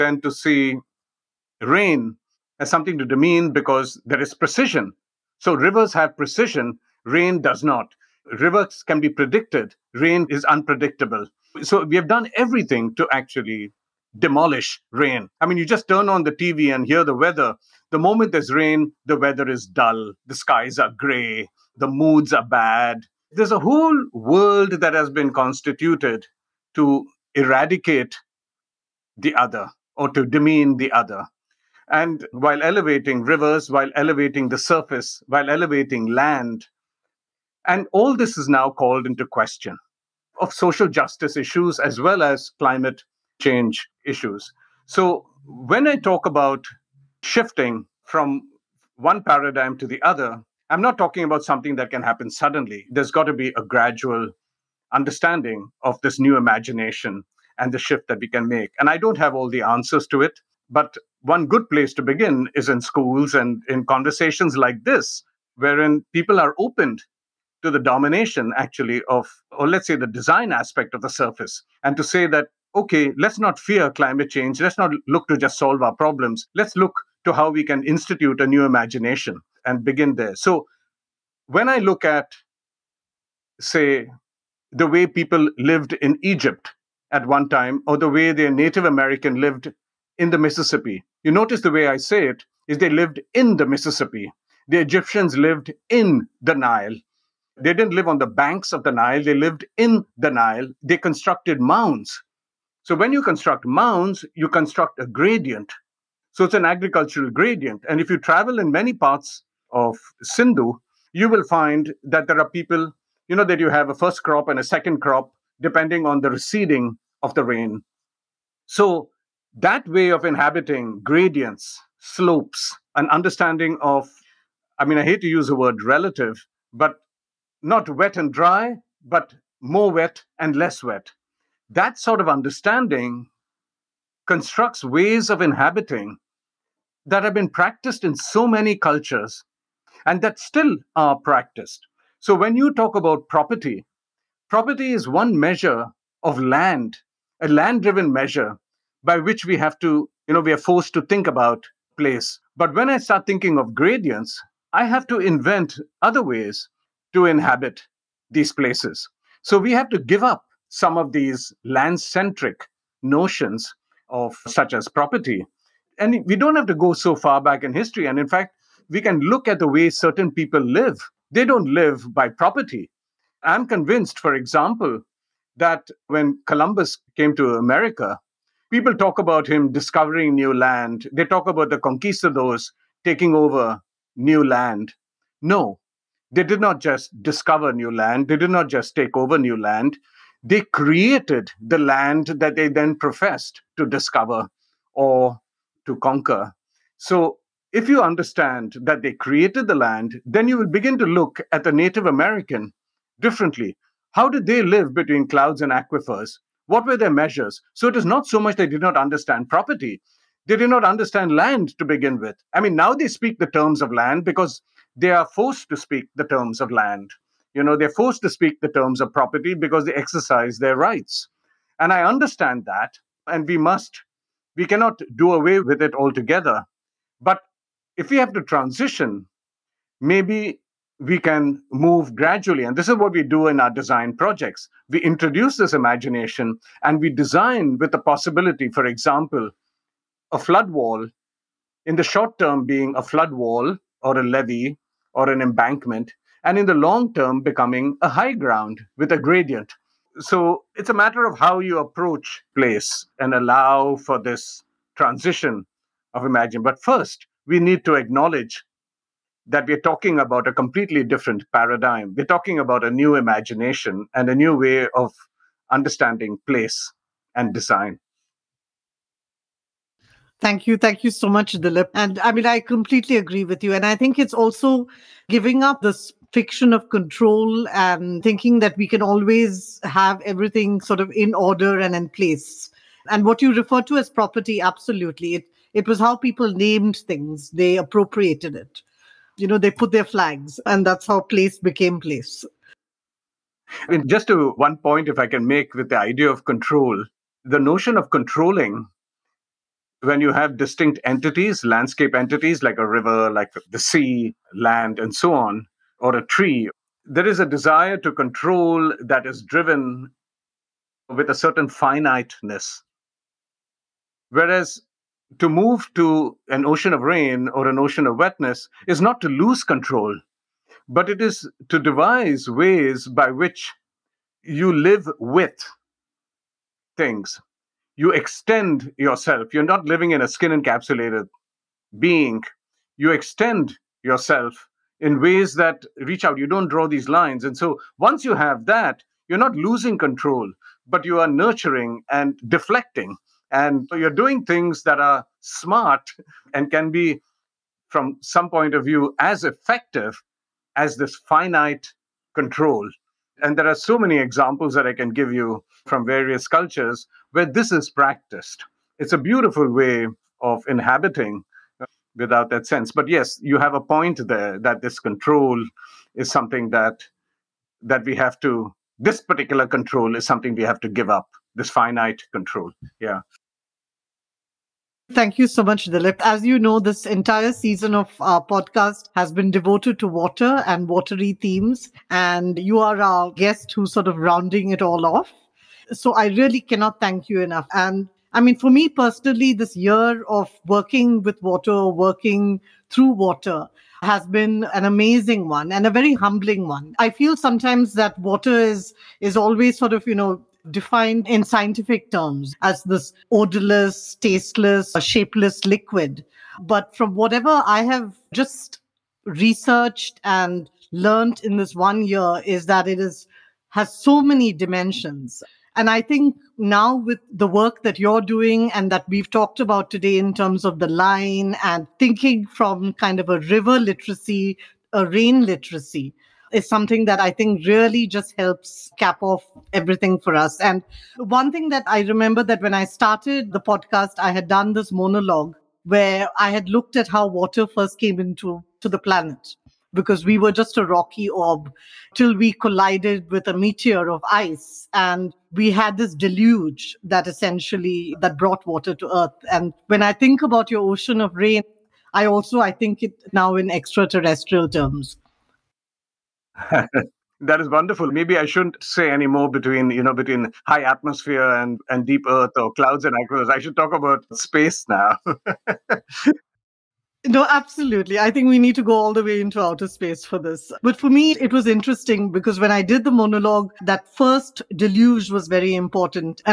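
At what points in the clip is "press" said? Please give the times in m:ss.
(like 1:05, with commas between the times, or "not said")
not said.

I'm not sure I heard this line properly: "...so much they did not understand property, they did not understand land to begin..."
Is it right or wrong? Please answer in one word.
right.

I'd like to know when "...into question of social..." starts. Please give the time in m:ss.
0:39.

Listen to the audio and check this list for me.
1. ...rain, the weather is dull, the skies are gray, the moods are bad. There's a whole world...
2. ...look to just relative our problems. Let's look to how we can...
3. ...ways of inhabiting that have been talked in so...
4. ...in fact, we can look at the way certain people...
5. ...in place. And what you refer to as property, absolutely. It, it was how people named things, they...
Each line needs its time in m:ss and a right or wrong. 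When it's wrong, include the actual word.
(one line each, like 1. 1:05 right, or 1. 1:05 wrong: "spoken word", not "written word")
1. 0:18 right
2. 1:15 wrong: "solve", not "relative"
3. 2:14 wrong: "practiced", not "talked"
4. 2:48 right
5. 4:41 right.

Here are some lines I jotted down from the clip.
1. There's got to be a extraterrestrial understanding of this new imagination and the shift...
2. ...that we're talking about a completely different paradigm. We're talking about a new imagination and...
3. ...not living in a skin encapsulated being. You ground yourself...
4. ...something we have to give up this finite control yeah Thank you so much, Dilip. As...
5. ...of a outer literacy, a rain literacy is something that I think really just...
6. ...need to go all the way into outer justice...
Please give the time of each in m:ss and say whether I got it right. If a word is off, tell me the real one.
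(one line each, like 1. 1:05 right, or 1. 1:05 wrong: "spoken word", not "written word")
1. 0:52 wrong: "gradual", not "extraterrestrial"
2. 4:19 right
3. 5:29 wrong: "extend", not "ground"
4. 6:10 right
5. 7:03 wrong: "river", not "outer"
6. 7:48 wrong: "space", not "justice".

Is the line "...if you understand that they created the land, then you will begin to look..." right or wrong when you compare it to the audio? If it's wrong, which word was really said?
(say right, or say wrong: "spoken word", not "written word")
right.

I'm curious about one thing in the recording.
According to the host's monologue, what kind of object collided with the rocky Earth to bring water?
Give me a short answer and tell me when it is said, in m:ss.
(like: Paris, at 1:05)
A meteor of ice, at 7:23.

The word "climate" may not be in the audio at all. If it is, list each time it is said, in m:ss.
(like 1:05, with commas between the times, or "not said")
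0:42, 1:13.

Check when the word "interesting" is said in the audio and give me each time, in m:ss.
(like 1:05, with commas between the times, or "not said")
7:51.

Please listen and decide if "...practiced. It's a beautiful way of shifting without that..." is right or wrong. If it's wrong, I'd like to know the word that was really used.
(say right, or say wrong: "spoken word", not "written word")
wrong: "inhabiting", not "shifting".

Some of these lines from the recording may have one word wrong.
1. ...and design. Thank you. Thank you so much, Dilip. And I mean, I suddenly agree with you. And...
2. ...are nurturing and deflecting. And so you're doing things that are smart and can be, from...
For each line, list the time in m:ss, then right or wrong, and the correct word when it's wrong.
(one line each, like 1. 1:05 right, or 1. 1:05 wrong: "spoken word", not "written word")
1. 4:27 wrong: "completely", not "suddenly"
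2. 5:41 right.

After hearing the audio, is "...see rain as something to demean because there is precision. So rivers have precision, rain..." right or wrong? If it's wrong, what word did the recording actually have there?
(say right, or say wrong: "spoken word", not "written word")
right.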